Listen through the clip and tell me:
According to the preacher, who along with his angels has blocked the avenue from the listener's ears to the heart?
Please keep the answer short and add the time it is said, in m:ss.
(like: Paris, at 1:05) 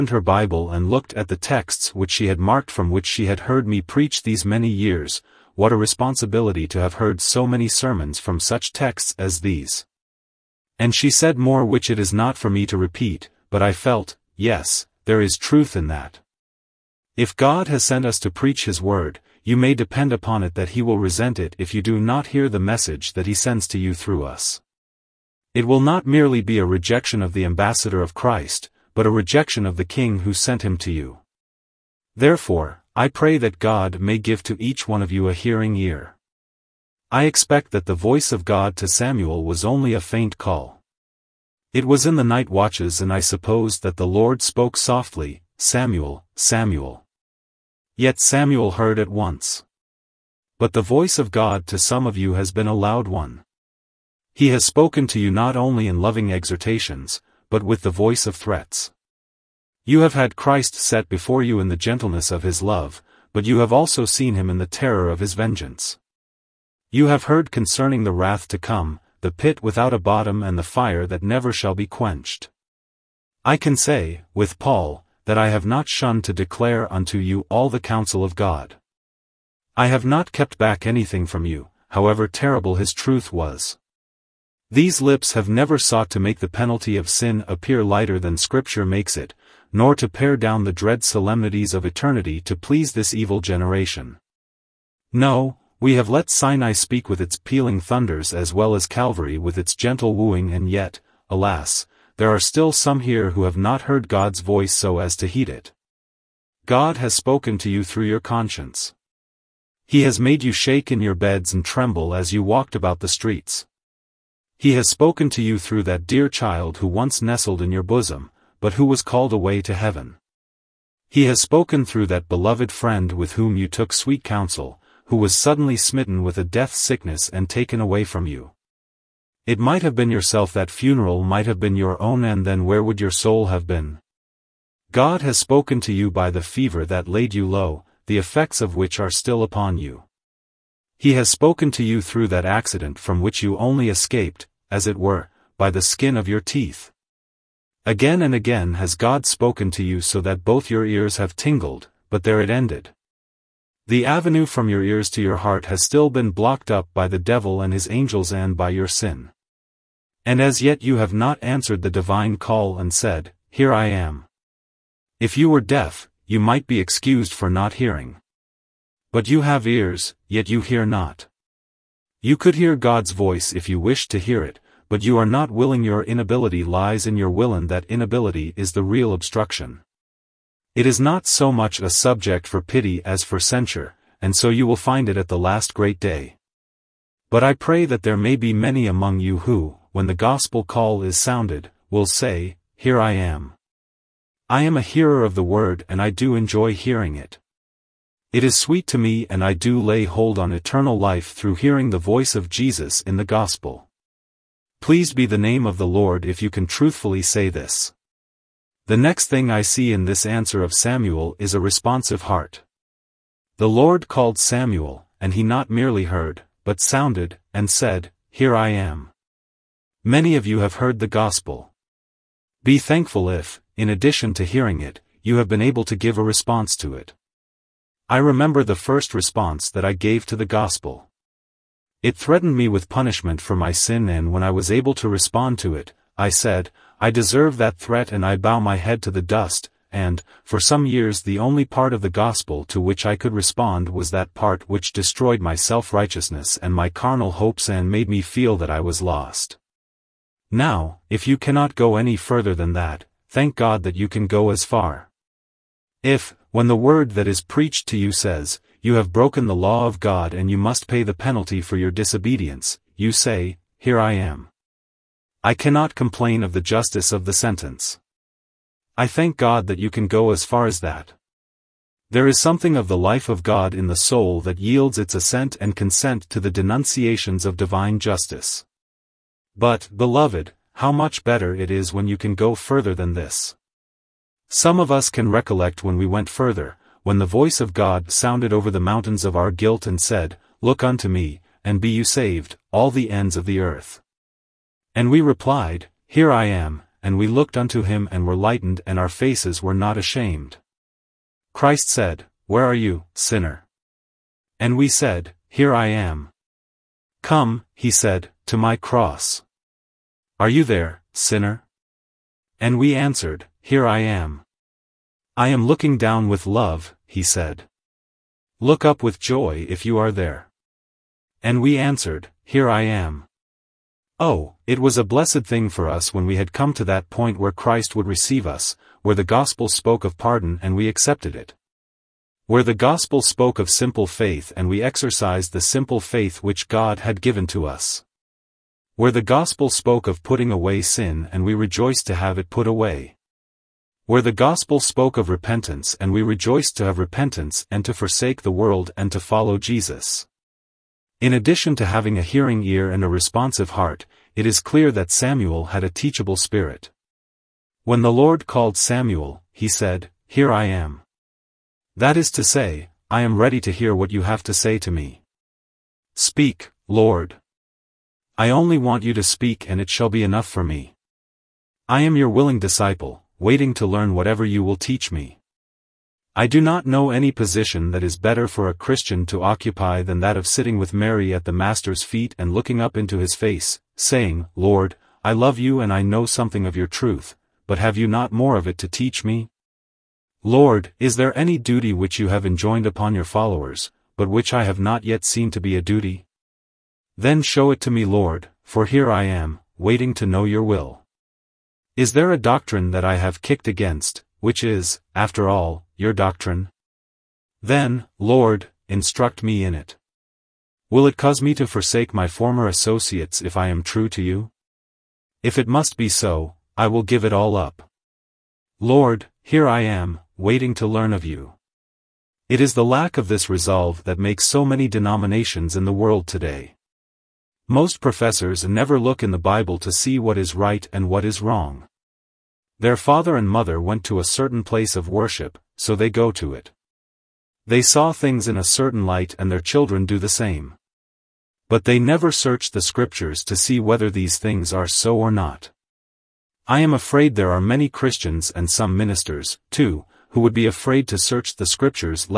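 the devil, at 2:37.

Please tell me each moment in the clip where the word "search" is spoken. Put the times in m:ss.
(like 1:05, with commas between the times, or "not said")
7:22, 7:31.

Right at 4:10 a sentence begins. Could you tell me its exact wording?
Now, if you cannot go any further than that, thank God that you can go as far.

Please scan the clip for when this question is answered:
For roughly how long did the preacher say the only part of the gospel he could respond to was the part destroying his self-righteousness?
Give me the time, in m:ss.
4:00.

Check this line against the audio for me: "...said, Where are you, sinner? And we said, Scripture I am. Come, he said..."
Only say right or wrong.
wrong.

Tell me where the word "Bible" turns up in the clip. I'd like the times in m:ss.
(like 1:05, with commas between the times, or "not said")
0:00, 7:09.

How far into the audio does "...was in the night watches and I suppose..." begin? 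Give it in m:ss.
0:41.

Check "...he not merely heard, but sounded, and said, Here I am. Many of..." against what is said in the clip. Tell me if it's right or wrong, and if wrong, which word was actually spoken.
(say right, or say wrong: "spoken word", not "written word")
right.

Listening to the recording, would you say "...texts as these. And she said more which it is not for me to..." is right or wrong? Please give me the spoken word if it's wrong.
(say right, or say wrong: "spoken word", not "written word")
right.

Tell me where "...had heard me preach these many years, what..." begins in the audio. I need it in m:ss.
0:03.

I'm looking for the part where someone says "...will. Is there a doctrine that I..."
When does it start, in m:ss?
6:40.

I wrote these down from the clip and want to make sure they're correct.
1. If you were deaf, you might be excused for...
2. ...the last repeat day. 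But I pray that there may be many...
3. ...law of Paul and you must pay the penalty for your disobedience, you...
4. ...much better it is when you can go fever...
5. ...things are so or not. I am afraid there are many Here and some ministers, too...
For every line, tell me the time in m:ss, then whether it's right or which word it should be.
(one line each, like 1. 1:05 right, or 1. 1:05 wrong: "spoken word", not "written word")
1. 2:45 right
2. 3:05 wrong: "great", not "repeat"
3. 4:19 wrong: "God", not "Paul"
4. 4:40 wrong: "further", not "fever"
5. 7:24 wrong: "Christians", not "Here".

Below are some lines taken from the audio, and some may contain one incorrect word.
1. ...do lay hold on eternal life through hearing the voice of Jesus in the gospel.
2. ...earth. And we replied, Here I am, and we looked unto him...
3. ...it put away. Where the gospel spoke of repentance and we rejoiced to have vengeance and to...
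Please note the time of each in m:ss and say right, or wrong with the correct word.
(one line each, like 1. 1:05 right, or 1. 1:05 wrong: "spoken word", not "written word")
1. 3:19 right
2. 4:53 right
3. 5:42 wrong: "repentance", not "vengeance".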